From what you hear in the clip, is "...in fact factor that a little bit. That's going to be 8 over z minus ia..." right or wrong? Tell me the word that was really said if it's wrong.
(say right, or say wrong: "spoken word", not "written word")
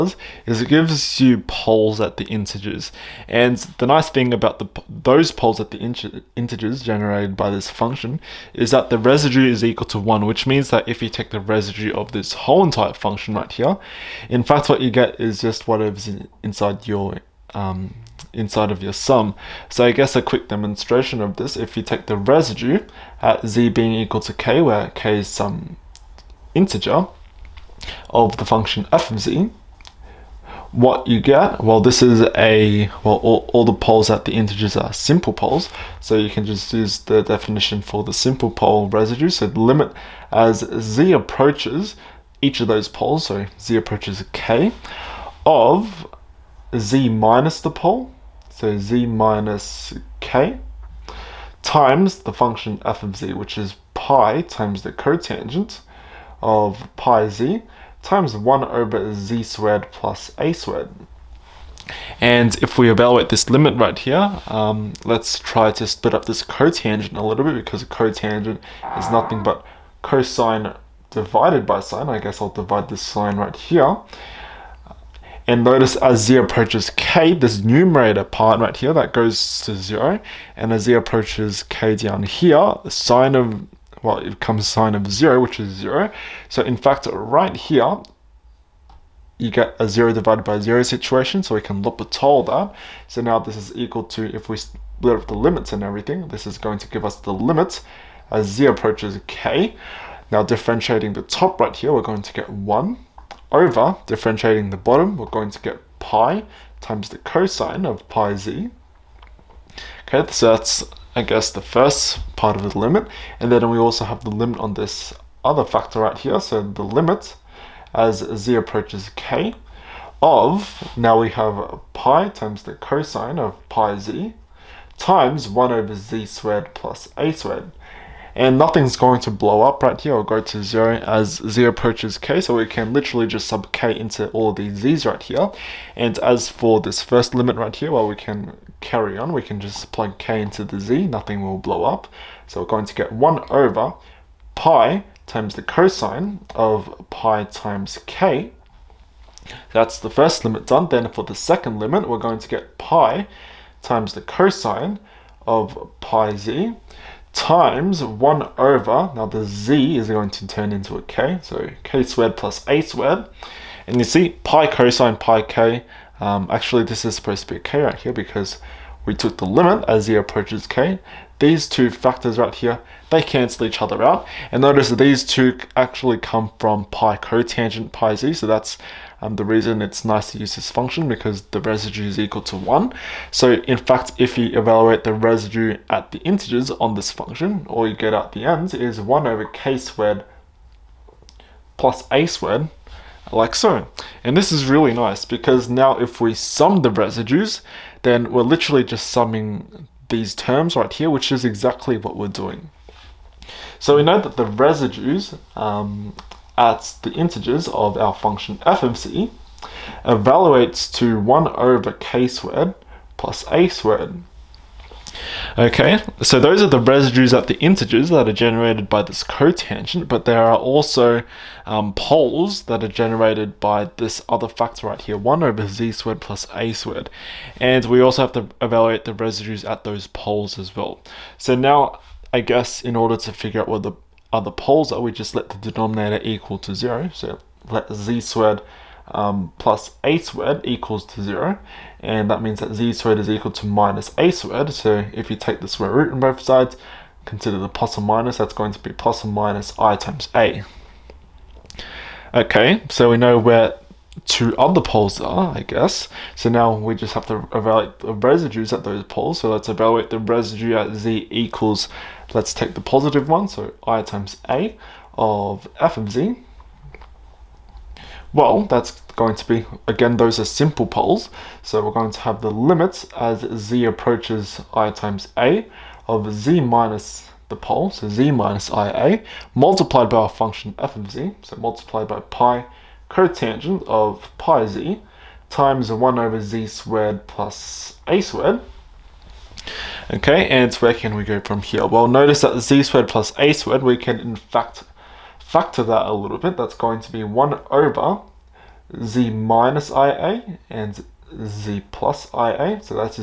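wrong: "1", not "8".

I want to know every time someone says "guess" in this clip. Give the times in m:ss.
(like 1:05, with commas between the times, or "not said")
0:19, 1:12, 1:51, 3:52, 4:15.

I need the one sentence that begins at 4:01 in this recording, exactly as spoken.
And that means that z squared is equal to minus a squared.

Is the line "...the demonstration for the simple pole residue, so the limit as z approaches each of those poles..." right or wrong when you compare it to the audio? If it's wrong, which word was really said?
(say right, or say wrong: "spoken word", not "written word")
wrong: "definition", not "demonstration".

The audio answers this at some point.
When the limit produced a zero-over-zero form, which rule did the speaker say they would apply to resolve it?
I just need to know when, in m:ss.
1:31.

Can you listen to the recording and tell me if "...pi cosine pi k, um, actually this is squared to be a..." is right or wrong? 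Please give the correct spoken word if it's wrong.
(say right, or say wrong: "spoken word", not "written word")
wrong: "supposed", not "squared".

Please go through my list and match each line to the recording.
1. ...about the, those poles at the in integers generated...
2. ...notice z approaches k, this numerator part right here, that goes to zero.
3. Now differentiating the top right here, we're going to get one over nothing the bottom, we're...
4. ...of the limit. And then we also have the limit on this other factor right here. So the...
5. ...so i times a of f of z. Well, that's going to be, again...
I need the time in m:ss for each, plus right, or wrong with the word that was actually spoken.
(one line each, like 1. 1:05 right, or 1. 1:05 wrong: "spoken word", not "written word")
1. 0:04 right
2. 1:15 right
3. 1:40 wrong: "differentiating", not "nothing"
4. 1:52 right
5. 4:23 right.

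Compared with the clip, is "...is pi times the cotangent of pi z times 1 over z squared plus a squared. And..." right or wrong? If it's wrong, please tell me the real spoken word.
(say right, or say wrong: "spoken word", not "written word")
right.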